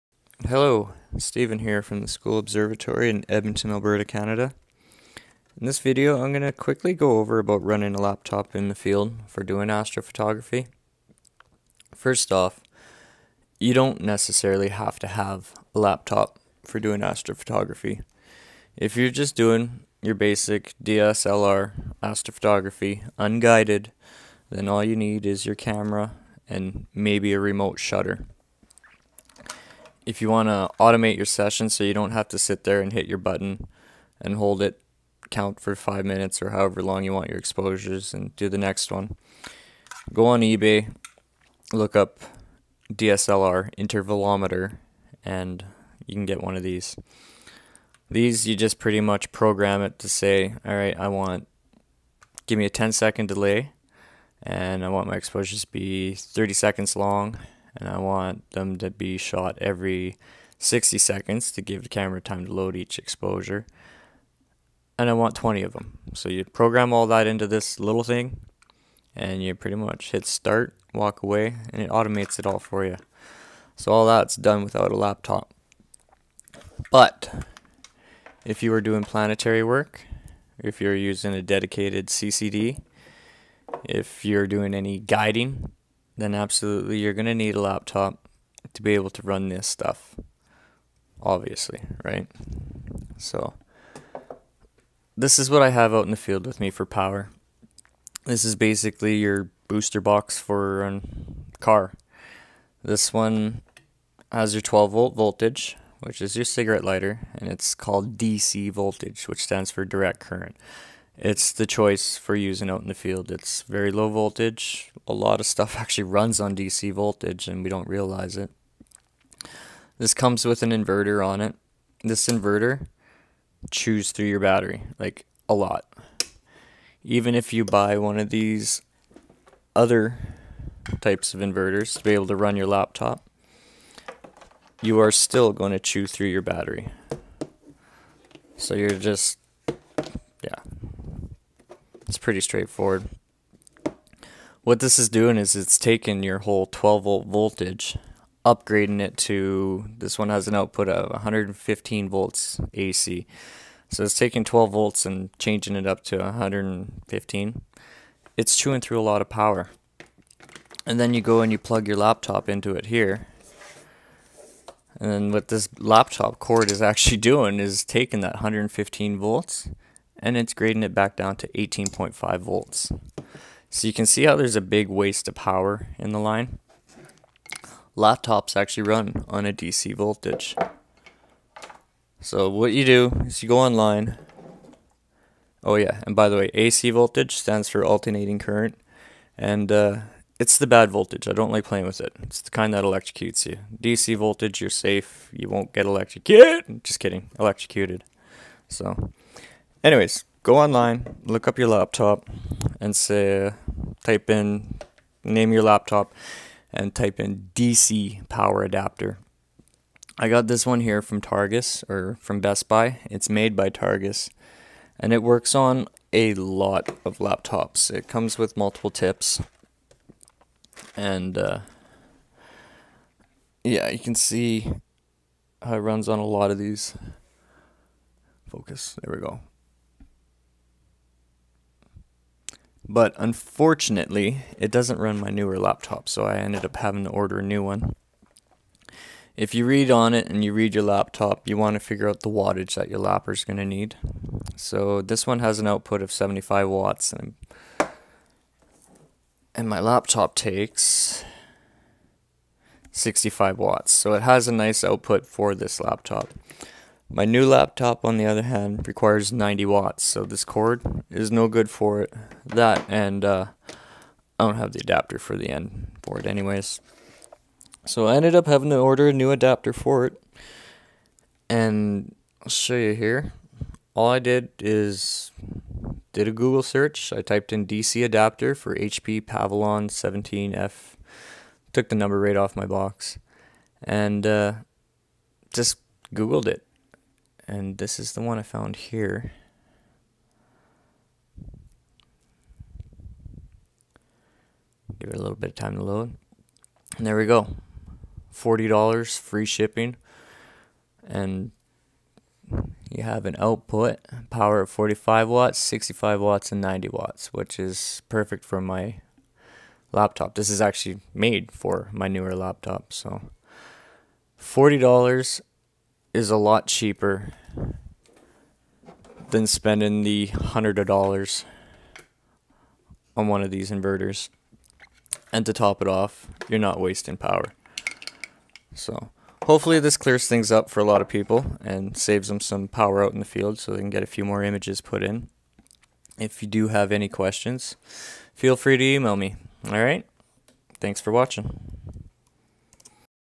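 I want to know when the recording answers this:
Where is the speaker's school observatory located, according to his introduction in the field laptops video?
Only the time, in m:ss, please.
0:03.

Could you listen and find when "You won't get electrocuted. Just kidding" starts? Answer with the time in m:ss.
3:15.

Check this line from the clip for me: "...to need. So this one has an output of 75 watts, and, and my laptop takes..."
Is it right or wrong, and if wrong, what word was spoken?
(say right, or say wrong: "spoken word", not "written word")
right.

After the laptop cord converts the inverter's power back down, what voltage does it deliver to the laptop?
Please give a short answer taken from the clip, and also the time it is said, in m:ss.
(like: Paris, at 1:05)
18.5 volts, at 2:51.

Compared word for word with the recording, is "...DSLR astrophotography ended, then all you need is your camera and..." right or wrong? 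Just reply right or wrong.
wrong.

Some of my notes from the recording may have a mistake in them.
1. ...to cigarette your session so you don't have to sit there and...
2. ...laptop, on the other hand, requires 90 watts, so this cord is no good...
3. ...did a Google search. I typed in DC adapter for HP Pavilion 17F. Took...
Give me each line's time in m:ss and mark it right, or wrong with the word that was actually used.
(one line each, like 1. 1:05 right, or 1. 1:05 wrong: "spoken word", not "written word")
1. 0:30 wrong: "automate", not "cigarette"
2. 4:17 right
3. 4:36 right.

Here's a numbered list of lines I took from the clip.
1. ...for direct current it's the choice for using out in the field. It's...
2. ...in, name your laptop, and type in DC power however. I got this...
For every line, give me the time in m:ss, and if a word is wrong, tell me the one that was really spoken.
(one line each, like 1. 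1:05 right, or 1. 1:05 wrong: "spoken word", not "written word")
1. 1:49 right
2. 3:24 wrong: "adapter", not "however".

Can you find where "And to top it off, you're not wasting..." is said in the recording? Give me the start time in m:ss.
5:25.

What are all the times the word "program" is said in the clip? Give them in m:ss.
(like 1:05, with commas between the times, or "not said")
0:49, 1:06.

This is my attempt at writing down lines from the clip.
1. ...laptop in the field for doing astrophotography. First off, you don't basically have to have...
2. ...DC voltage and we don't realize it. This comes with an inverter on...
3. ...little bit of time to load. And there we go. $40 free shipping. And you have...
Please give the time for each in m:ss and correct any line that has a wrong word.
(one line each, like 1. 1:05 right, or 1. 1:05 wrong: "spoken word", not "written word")
1. 0:08 wrong: "necessarily", not "basically"
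2. 1:56 right
3. 4:55 right.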